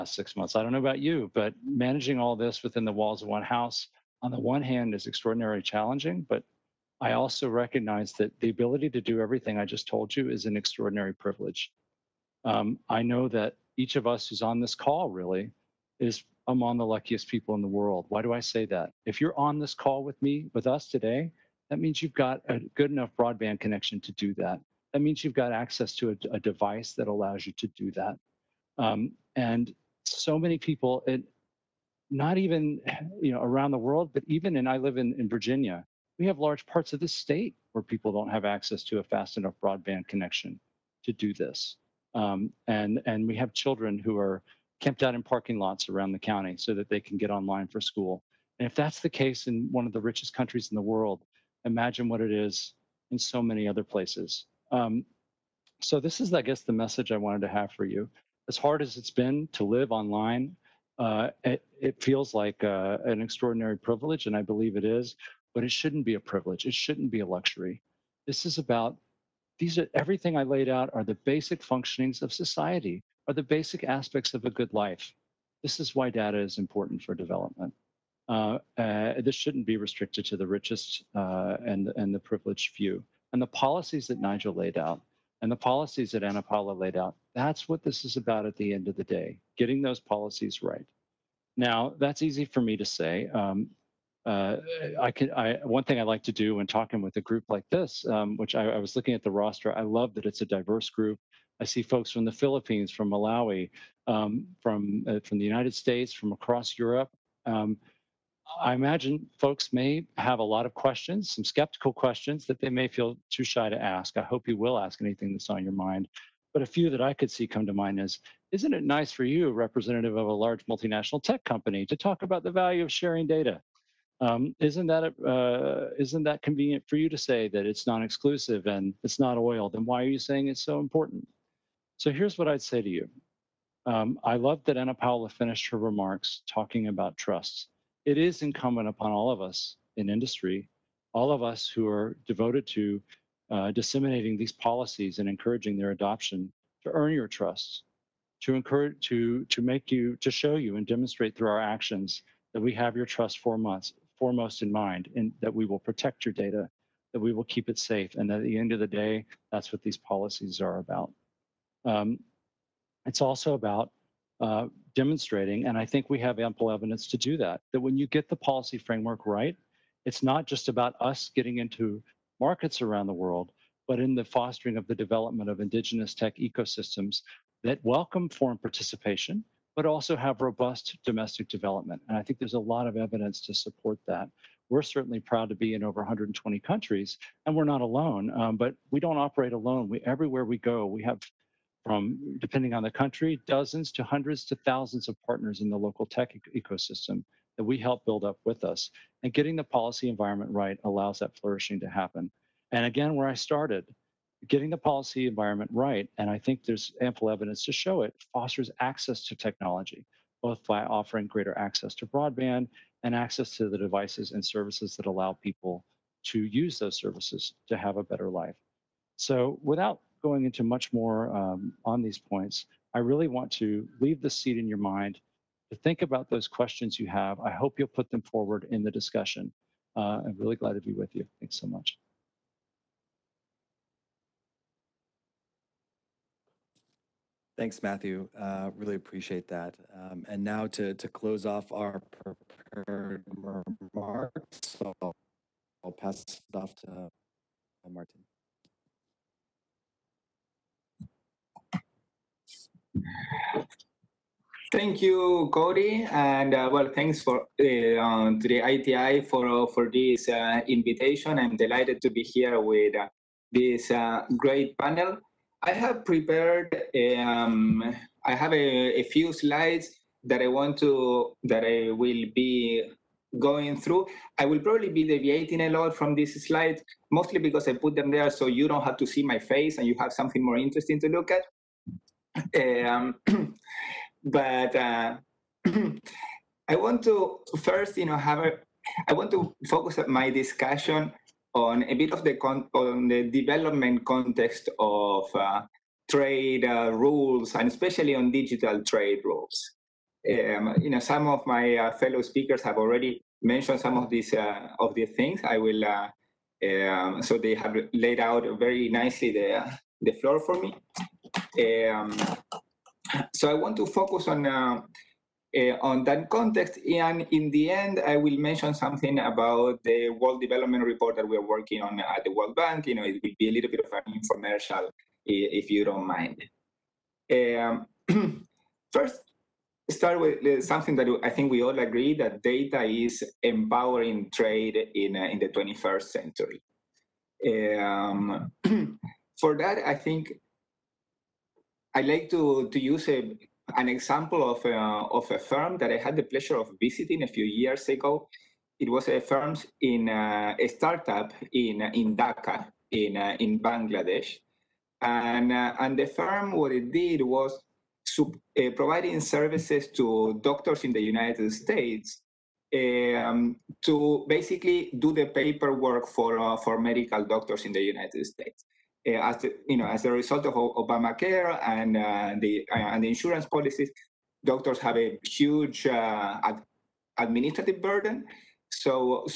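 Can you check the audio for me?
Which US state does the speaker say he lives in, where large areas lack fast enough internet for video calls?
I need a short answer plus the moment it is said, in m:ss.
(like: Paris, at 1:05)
Virginia, at 0:35.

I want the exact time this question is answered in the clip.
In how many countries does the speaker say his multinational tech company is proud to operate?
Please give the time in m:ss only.
3:05.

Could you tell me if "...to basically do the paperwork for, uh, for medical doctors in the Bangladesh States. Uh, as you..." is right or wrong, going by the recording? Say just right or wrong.
wrong.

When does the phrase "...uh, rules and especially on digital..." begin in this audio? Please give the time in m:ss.
4:56.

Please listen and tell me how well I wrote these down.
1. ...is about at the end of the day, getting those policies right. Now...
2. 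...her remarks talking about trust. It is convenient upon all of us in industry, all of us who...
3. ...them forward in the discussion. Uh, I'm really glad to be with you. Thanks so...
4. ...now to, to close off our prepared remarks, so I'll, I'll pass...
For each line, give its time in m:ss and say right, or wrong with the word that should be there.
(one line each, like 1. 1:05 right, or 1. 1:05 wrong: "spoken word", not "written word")
1. 1:28 right
2. 2:15 wrong: "incumbent", not "convenient"
3. 3:48 right
4. 4:00 right.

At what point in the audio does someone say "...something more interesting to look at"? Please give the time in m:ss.
4:40.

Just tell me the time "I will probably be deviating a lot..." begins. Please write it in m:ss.
4:34.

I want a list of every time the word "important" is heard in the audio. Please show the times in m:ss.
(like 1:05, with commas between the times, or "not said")
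1:16, 2:10.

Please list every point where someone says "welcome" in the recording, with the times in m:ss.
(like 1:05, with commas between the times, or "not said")
2:57.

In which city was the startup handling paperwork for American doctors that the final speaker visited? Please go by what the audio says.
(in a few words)
Dhaka.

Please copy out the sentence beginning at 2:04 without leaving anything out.
Um, isn't that uh, isn't that convenient for you to say that it's non-exclusive and it's not oil?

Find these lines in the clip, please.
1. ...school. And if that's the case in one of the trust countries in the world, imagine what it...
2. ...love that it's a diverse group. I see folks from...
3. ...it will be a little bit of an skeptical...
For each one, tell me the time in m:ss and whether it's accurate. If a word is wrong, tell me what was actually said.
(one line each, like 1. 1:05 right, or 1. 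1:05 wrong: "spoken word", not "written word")
1. 0:47 wrong: "richest", not "trust"
2. 1:39 right
3. 5:23 wrong: "infomercial", not "skeptical".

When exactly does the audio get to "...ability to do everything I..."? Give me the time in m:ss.
0:08.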